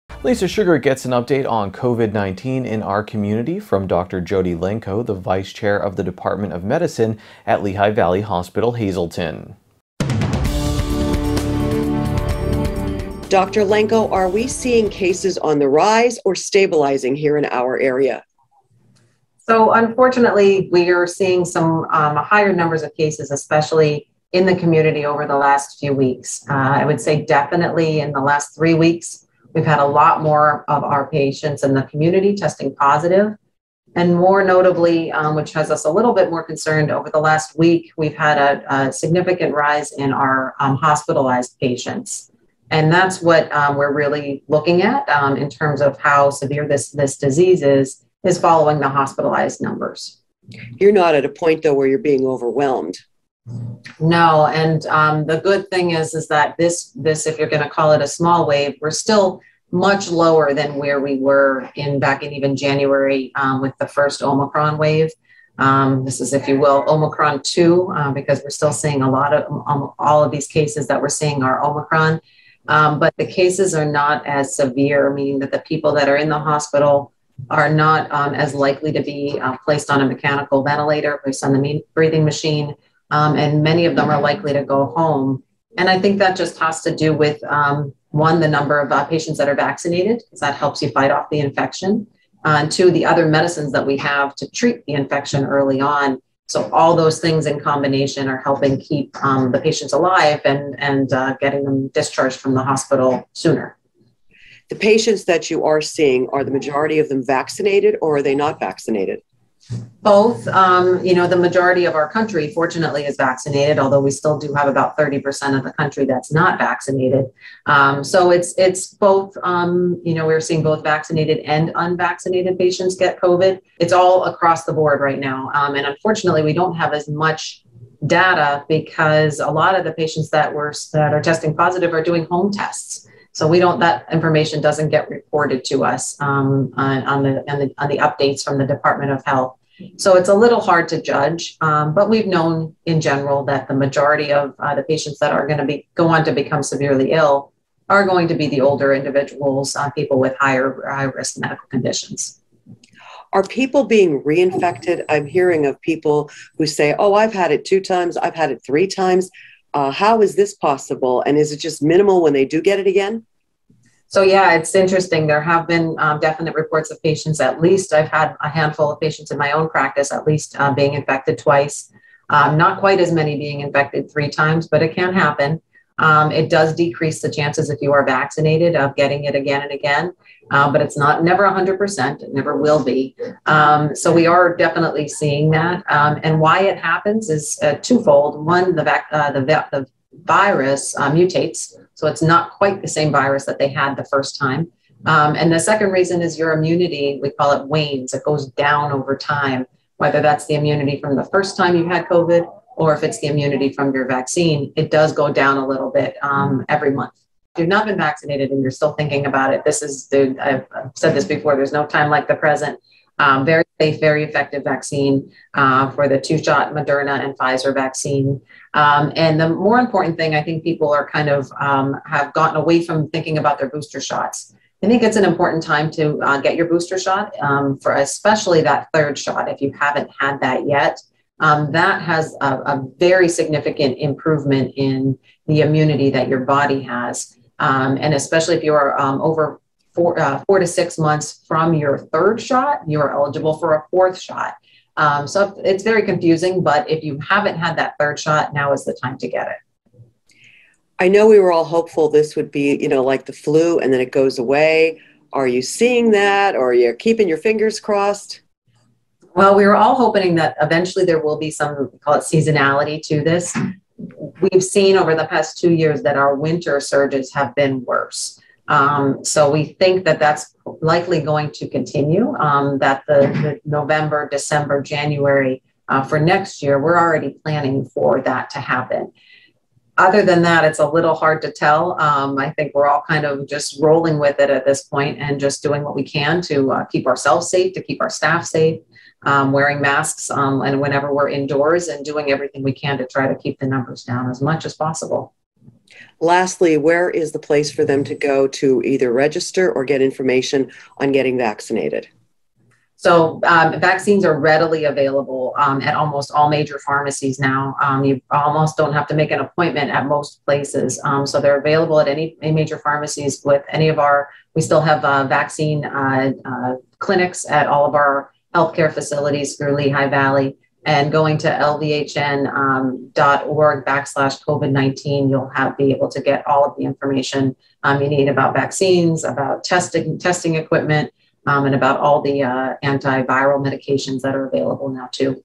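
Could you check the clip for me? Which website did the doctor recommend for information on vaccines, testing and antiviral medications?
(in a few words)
lvhn.org.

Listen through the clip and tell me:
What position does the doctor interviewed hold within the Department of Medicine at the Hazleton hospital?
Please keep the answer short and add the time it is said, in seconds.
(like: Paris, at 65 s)
Vice Chair, at 5 s.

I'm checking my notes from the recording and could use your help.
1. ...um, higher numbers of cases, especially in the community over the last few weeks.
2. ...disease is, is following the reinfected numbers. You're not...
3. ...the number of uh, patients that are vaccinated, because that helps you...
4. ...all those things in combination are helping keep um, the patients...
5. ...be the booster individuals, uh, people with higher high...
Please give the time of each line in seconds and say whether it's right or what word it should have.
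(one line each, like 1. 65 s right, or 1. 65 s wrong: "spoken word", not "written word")
1. 21 s right
2. 47 s wrong: "hospitalized", not "reinfected"
3. 88 s right
4. 96 s right
5. 148 s wrong: "older", not "booster".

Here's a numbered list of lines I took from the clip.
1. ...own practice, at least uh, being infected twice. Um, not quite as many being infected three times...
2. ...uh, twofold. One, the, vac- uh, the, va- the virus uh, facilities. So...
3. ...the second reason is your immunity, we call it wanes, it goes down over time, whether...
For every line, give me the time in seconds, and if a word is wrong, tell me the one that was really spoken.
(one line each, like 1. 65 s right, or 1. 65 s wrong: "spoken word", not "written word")
1. 169 s right
2. 187 s wrong: "mutates", not "facilities"
3. 195 s right.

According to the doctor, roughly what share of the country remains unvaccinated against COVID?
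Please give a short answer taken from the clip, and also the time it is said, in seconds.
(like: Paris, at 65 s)
30%, at 114 s.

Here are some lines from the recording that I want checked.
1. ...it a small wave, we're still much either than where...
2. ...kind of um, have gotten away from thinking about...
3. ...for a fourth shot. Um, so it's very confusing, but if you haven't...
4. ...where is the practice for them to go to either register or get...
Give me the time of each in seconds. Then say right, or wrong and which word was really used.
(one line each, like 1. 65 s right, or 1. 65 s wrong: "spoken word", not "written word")
1. 57 s wrong: "lower", not "either"
2. 221 s right
3. 243 s right
4. 296 s wrong: "place", not "practice".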